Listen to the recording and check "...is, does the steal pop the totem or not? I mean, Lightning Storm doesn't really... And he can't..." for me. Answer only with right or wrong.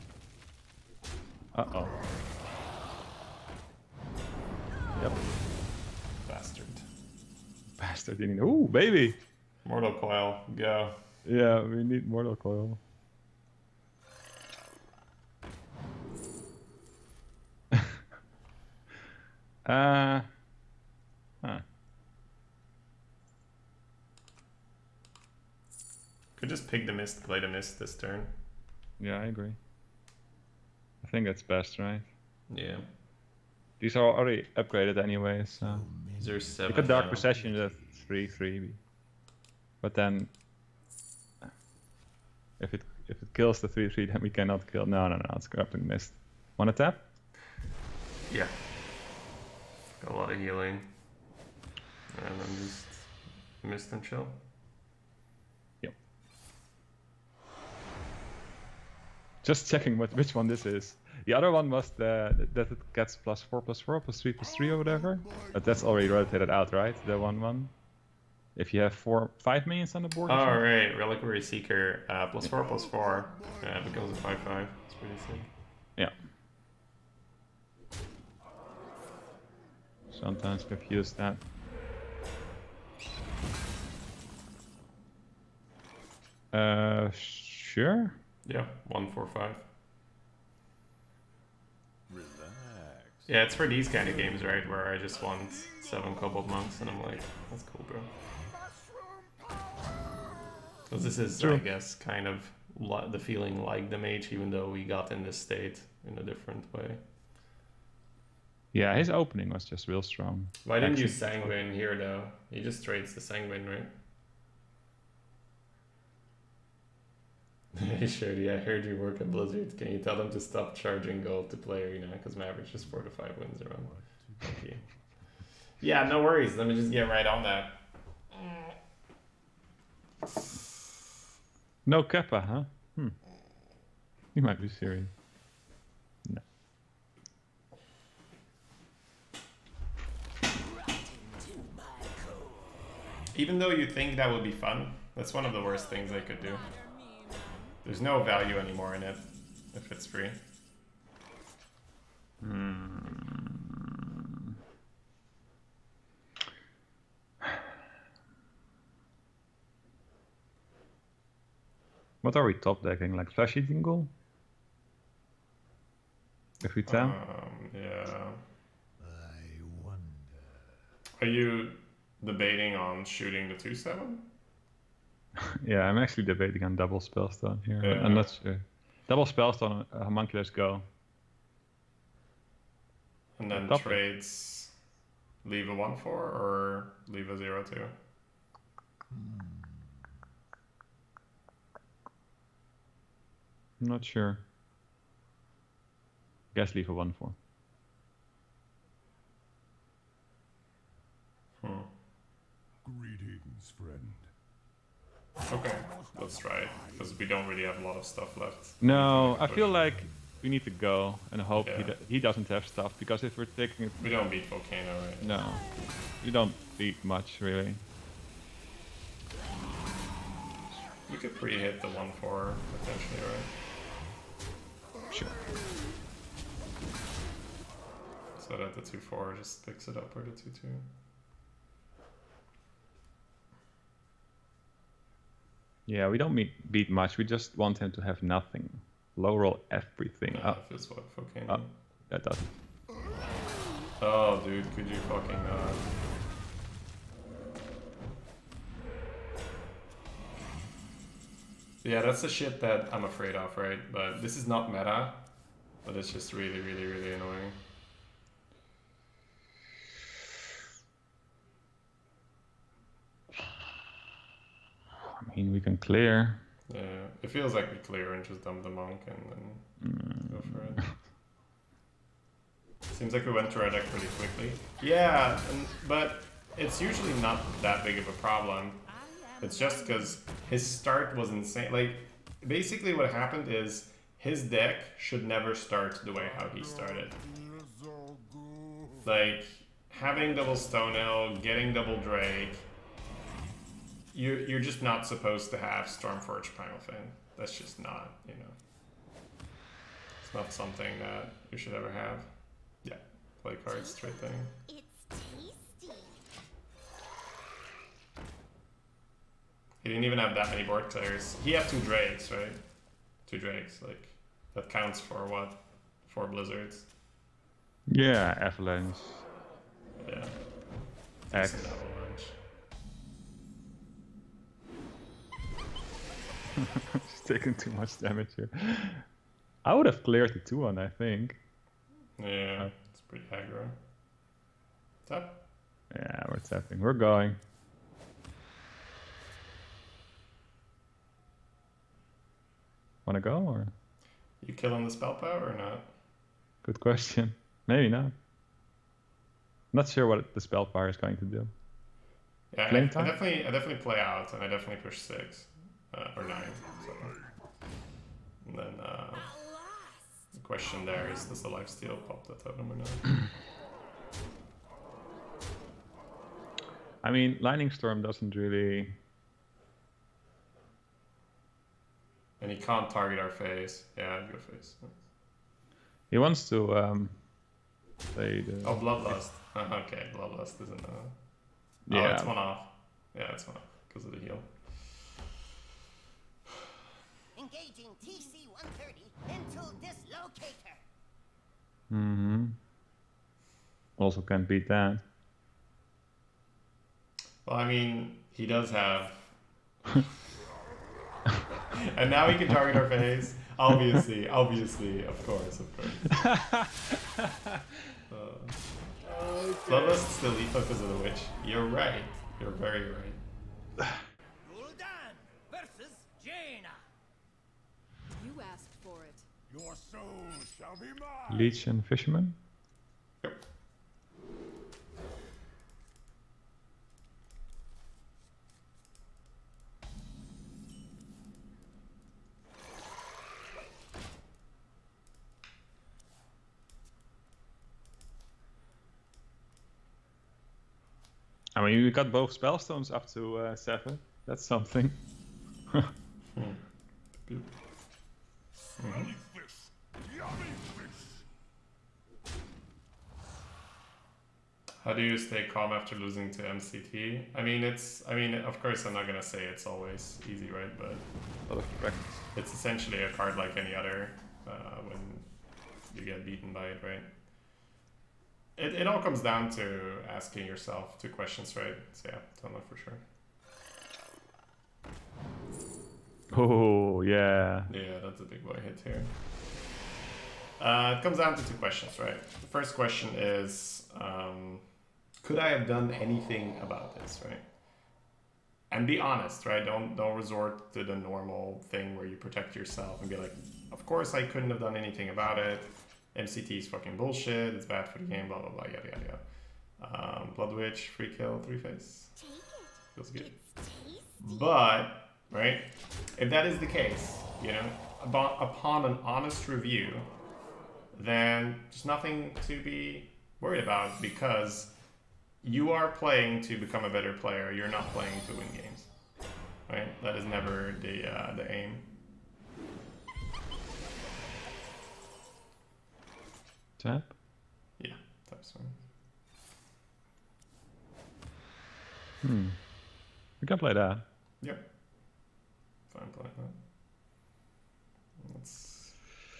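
right.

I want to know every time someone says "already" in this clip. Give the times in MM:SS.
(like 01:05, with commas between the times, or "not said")
00:34, 01:05.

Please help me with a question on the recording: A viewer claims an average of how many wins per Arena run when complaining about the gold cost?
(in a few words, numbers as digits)
four to five.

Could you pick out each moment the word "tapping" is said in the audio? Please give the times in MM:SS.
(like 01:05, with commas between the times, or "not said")
05:36.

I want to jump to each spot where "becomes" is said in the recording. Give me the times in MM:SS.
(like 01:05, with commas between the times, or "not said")
01:13, 08:36.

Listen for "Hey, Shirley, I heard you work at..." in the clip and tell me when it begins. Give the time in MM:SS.
01:57.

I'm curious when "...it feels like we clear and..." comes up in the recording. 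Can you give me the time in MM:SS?
04:27.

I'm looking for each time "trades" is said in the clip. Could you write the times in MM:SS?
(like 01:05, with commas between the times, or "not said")
01:52, 03:03.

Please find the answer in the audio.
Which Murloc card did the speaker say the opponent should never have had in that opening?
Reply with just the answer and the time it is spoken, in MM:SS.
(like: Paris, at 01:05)
Primal Fin, at 04:56.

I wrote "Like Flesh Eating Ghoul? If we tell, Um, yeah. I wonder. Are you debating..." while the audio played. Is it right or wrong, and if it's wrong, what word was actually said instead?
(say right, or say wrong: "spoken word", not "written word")
right.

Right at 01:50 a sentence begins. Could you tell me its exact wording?
Why didn't Actually, you Sanguine here, though?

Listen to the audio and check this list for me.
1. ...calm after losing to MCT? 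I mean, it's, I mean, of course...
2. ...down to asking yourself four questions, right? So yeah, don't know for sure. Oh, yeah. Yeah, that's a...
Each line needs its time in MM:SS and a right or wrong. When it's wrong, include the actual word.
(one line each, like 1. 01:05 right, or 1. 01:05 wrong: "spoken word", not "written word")
1. 07:35 right
2. 07:49 wrong: "two", not "four".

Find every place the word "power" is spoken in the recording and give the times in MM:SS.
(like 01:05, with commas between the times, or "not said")
05:45, 05:50.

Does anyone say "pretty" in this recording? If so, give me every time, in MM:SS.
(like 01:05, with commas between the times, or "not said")
01:14, 04:33, 05:33.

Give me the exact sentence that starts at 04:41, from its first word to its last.
Like, basically what happened is his deck should never start the way how he started.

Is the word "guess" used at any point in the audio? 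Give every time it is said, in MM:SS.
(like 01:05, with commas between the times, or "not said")
01:41, 03:16.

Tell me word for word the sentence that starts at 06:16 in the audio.
He wants to um, play the...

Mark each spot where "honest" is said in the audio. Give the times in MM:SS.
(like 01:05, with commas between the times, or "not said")
08:09, 08:29.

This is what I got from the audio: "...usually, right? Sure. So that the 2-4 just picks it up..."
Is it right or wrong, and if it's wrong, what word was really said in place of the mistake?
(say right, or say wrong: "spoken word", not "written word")
wrong: "potentially", not "usually".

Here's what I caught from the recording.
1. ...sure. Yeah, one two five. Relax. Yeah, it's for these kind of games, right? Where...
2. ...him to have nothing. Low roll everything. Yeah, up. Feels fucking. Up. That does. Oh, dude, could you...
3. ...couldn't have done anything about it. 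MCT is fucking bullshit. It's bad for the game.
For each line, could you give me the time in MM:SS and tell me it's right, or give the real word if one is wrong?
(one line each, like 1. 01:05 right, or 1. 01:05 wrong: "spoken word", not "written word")
1. 01:27 wrong: "four", not "two"
2. 03:57 right
3. 08:14 right.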